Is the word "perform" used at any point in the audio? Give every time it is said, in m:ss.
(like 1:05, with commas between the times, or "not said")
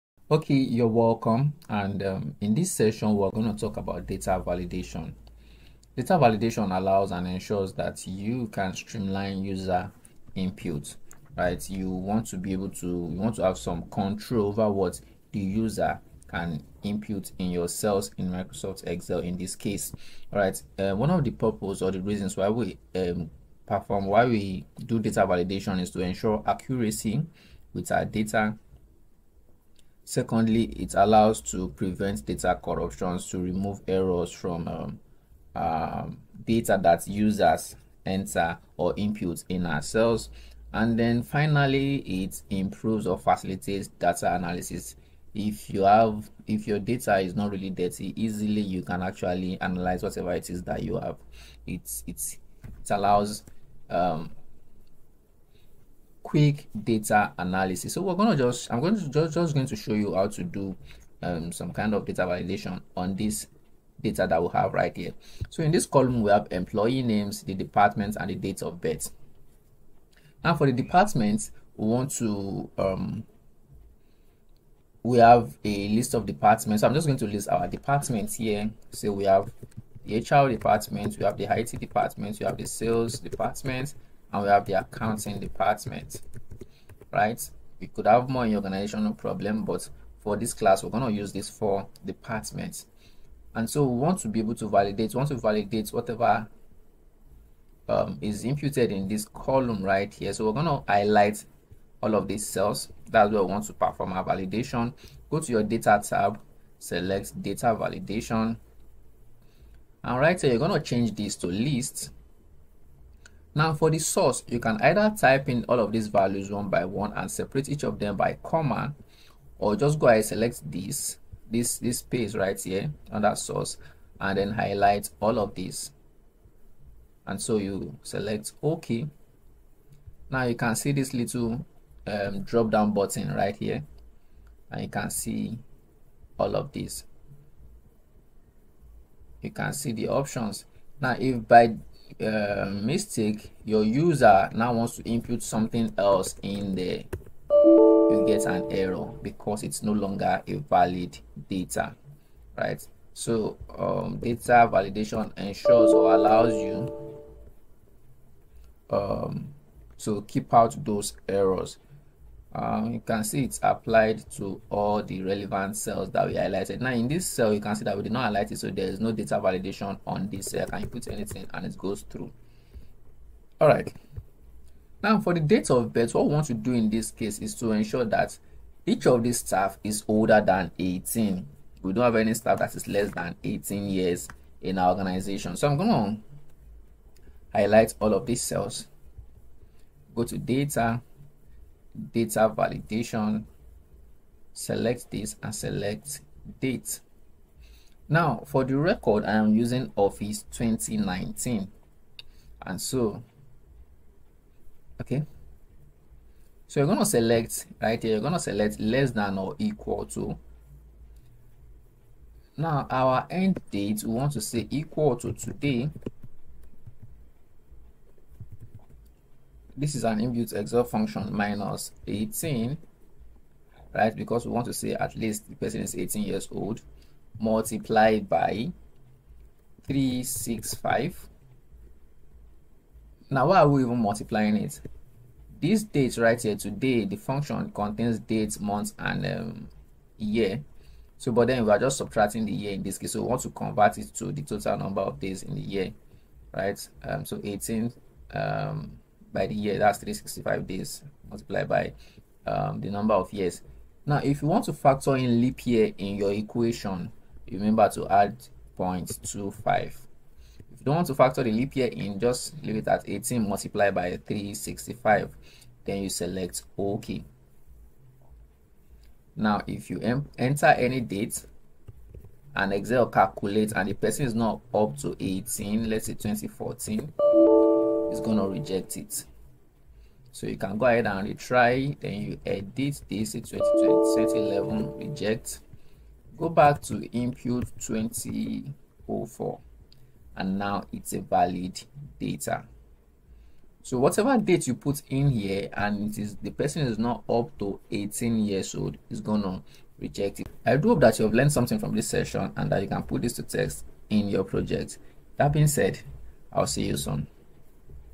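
0:23, 1:43.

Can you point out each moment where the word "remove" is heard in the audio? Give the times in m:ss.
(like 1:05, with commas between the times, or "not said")
0:33.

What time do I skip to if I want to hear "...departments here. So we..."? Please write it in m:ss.
1:17.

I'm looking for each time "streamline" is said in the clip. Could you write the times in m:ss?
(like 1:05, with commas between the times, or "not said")
0:08.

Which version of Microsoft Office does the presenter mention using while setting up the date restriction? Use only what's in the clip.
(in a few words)
Office 2019.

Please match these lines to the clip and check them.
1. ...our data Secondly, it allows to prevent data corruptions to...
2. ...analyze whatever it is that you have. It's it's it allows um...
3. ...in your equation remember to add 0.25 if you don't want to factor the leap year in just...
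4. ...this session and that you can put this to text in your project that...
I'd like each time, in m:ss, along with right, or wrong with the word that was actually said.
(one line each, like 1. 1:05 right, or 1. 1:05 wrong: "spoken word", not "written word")
1. 0:27 right
2. 0:49 right
3. 4:15 right
4. 5:01 right.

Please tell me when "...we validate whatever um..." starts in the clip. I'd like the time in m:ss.
1:35.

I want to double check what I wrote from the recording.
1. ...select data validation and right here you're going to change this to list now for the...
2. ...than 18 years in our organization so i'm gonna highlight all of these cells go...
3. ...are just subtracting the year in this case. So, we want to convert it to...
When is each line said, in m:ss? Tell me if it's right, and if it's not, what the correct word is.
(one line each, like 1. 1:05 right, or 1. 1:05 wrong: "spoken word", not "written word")
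1. 1:46 right
2. 3:03 right
3. 4:01 right.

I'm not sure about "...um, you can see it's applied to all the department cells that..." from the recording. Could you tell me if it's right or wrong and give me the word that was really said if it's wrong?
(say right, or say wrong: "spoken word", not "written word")
wrong: "relevant", not "department".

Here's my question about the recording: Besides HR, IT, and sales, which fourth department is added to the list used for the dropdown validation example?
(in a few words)
Accounting.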